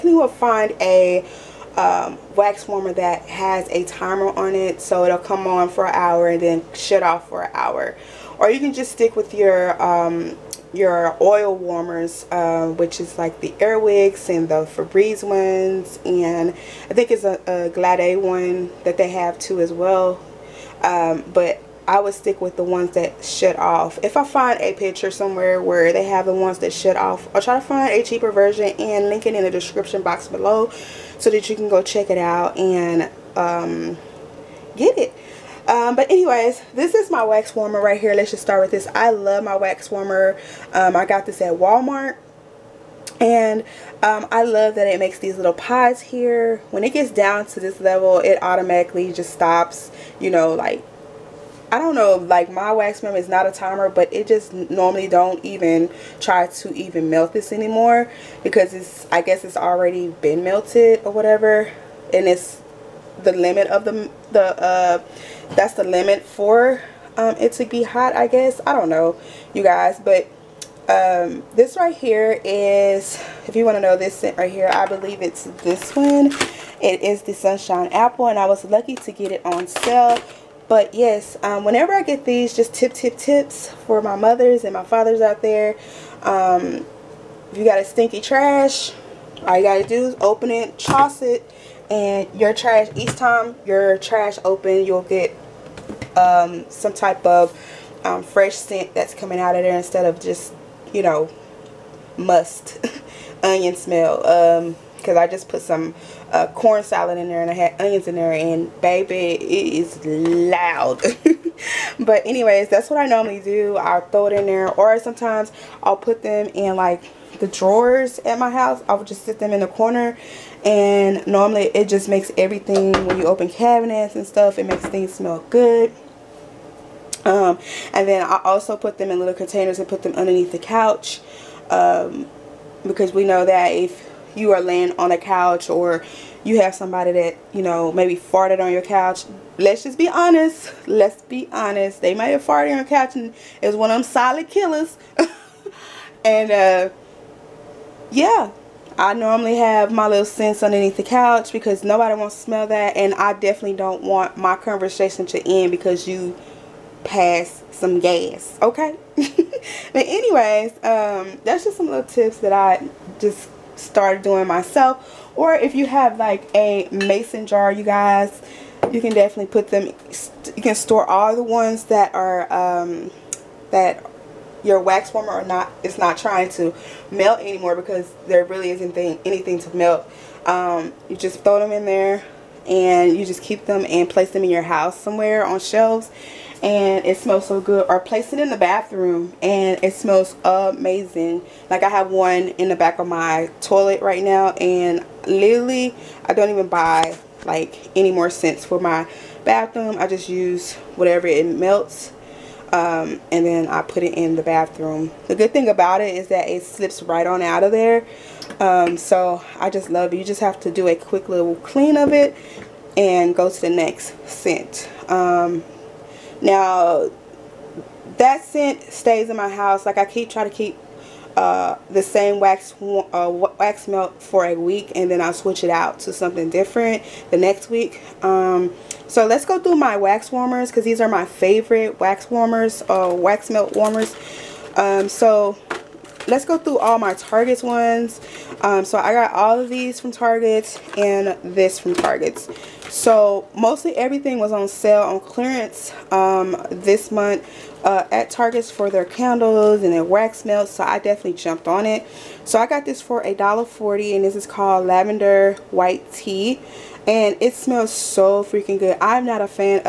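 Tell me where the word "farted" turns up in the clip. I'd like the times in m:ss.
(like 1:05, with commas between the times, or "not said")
2:18, 2:22.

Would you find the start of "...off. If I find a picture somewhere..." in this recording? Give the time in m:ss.
0:23.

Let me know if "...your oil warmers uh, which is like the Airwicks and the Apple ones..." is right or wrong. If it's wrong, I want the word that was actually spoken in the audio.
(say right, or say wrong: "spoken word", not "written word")
wrong: "Febreze", not "Apple".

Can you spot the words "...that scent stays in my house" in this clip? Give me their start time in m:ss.
3:38.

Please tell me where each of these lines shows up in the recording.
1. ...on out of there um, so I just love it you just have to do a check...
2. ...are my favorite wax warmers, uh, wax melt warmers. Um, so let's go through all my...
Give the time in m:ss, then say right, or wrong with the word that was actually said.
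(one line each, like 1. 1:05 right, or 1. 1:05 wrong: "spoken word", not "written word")
1. 3:27 wrong: "quick", not "check"
2. 3:50 right.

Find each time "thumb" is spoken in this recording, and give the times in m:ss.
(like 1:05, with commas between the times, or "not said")
not said.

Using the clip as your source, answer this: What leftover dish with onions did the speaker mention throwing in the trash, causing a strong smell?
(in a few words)
corn salad.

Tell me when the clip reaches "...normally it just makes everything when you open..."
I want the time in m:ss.
2:01.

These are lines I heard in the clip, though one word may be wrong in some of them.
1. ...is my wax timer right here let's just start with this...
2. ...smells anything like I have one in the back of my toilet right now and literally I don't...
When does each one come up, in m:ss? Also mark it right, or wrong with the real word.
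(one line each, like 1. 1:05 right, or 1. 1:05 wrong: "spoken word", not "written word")
1. 0:36 wrong: "warmer", not "timer"
2. 3:09 wrong: "amazing", not "anything".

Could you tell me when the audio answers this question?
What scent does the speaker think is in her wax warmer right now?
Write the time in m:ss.
1:17.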